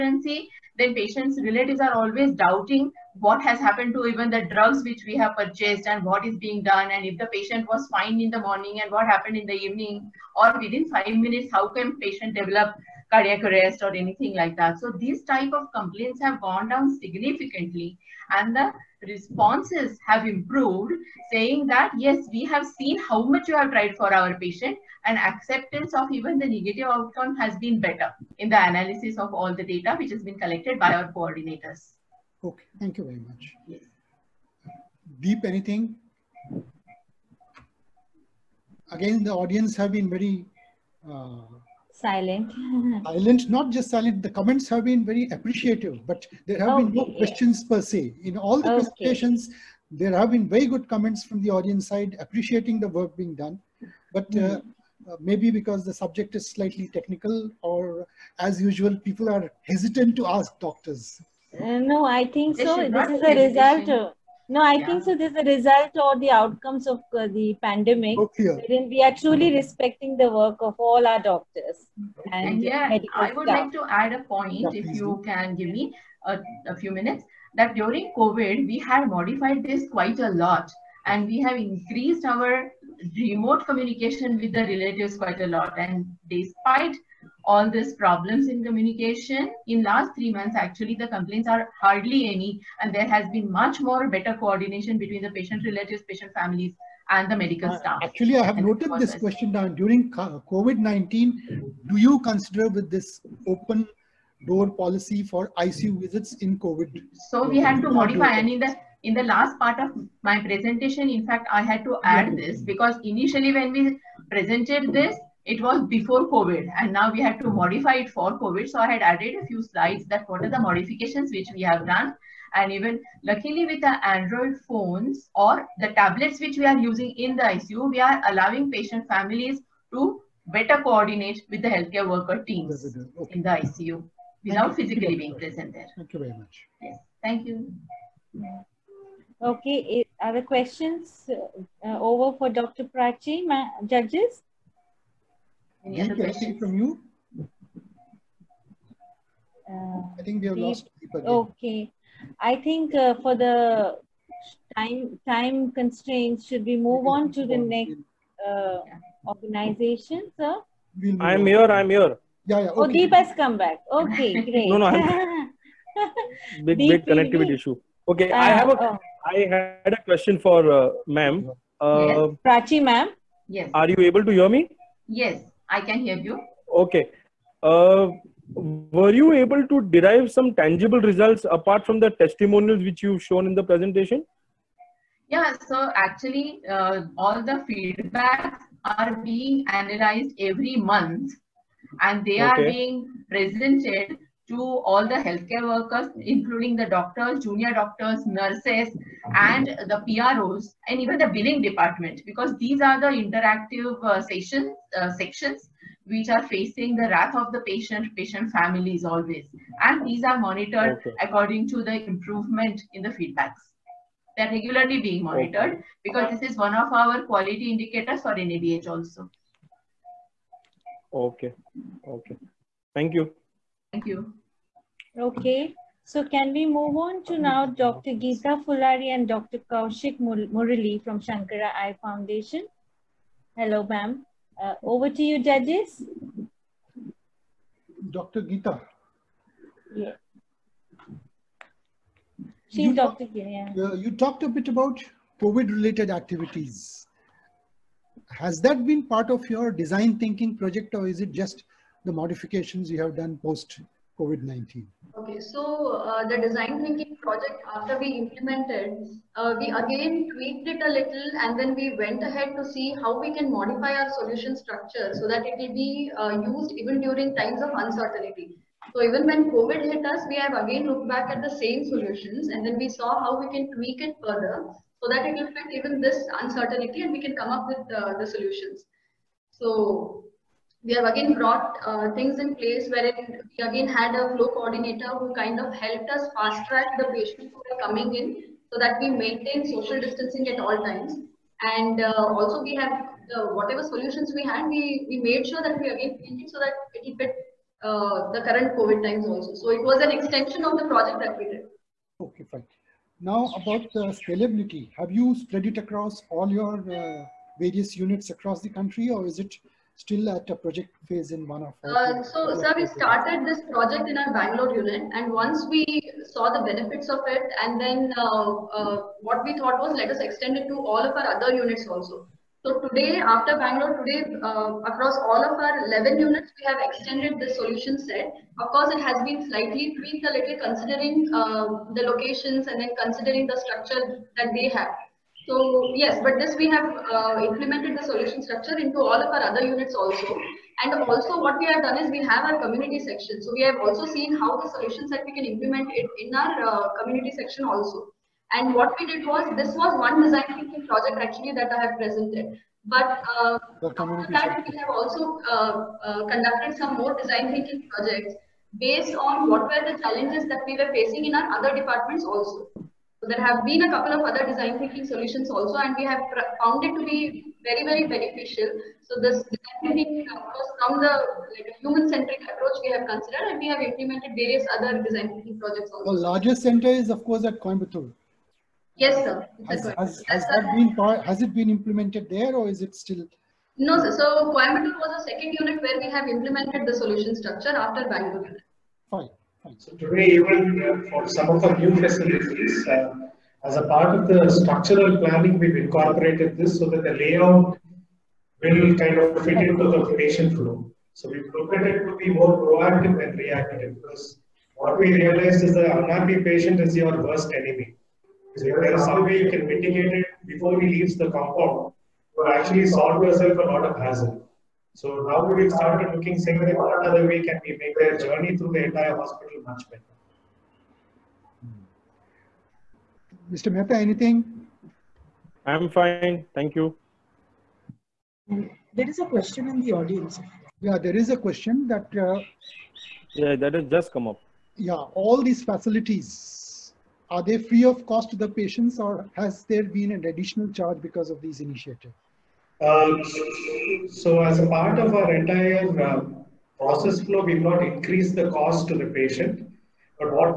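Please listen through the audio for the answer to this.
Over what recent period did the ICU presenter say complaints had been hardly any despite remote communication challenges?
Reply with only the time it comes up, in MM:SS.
01:29.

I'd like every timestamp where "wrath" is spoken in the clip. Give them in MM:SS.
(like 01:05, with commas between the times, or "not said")
03:27.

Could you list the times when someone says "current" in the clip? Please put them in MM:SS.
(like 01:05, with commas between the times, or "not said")
04:58.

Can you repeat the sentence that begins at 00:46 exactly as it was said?
been no questions per se in all the okay.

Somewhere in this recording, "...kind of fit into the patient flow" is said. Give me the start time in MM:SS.
06:38.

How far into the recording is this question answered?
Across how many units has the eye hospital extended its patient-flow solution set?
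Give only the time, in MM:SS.
05:25.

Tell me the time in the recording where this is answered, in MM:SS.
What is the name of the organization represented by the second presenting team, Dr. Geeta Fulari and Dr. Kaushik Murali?
03:51.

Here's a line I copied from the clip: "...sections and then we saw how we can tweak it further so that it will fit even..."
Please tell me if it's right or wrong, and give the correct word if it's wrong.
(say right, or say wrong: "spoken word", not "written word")
wrong: "solutions", not "sections".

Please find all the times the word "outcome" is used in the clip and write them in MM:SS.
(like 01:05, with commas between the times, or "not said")
00:26, 01:06.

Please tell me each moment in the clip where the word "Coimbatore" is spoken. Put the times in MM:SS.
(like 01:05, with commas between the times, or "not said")
06:17, 06:24.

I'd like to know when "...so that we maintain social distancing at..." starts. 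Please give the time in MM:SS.
04:48.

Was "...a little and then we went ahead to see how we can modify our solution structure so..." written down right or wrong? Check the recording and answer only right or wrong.
right.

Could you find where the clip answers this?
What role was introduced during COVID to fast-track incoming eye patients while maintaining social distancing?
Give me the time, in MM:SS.
04:44.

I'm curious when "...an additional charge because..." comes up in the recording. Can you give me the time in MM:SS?
07:20.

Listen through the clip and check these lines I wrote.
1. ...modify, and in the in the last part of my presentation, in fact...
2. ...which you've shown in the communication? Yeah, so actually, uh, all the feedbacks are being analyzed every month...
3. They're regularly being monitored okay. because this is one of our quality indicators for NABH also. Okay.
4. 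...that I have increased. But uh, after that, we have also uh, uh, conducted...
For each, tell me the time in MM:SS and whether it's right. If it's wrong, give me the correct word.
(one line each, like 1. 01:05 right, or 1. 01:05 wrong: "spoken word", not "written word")
1. 01:47 right
2. 03:02 wrong: "presentation", not "communication"
3. 03:34 right
4. 05:51 wrong: "presented", not "increased".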